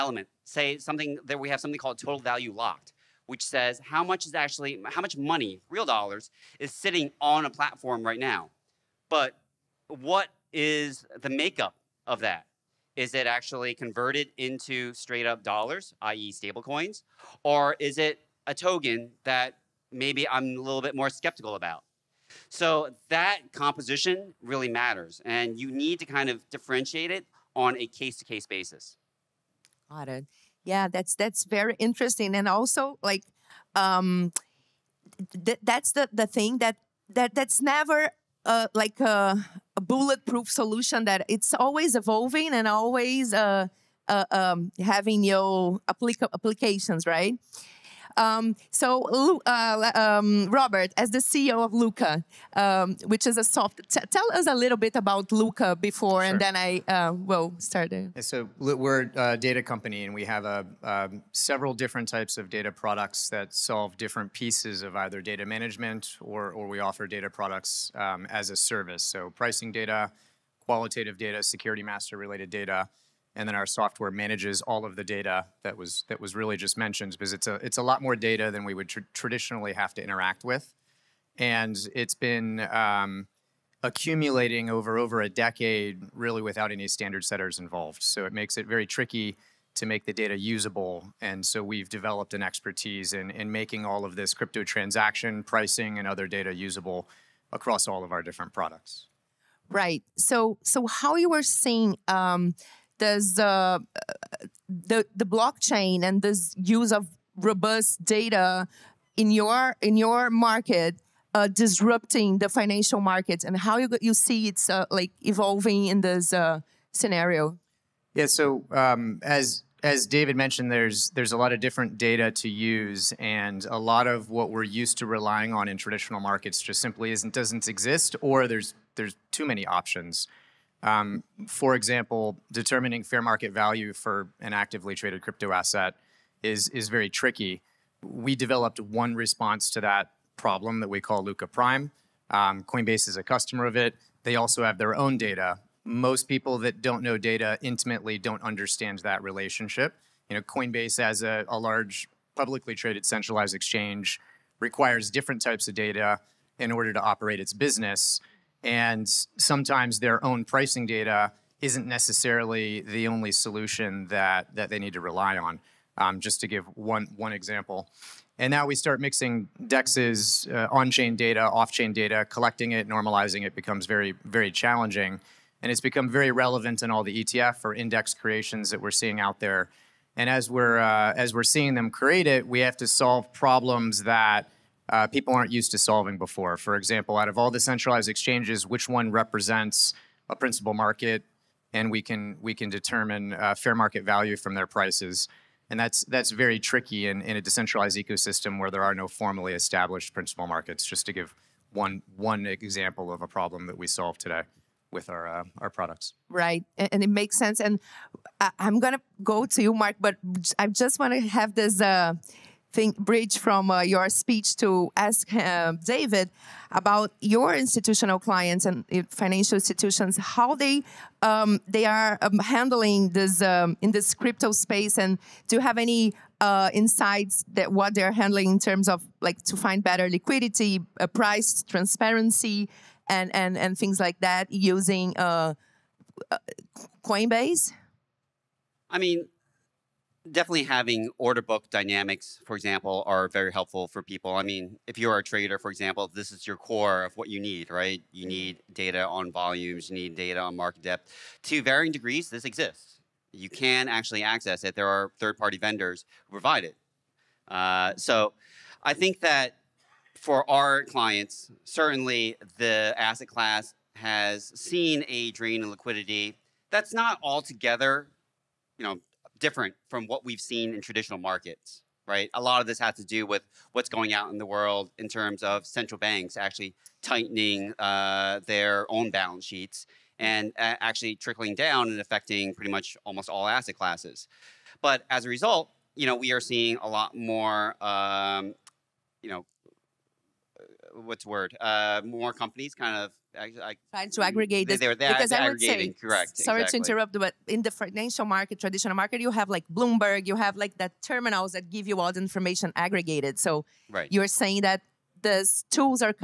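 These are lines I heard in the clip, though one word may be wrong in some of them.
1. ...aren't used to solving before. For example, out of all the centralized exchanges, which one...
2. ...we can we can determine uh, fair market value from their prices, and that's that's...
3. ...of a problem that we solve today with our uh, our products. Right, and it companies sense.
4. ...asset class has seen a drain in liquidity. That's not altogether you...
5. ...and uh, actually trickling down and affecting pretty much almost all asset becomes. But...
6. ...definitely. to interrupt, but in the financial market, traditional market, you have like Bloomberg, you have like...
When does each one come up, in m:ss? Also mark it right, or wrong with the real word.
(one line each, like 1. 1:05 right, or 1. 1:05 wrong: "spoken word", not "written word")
1. 3:05 right
2. 3:11 right
3. 3:23 wrong: "makes", not "companies"
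4. 4:22 right
5. 4:40 wrong: "classes", not "becomes"
6. 4:56 wrong: "exactly", not "definitely".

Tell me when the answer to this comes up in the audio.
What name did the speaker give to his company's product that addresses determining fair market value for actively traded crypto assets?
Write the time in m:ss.
2:21.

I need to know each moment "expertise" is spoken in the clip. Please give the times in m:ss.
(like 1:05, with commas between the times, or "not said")
1:32.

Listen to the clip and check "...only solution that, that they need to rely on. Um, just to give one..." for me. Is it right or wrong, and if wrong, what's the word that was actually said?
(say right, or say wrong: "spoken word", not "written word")
right.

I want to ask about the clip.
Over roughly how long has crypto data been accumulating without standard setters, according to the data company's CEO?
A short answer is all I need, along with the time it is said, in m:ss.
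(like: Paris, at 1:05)
a decade, at 1:24.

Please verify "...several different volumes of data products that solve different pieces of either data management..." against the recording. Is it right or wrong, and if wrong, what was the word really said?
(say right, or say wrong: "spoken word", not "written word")
wrong: "types", not "volumes".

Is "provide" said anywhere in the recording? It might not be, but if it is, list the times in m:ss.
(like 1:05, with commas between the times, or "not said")
4:16.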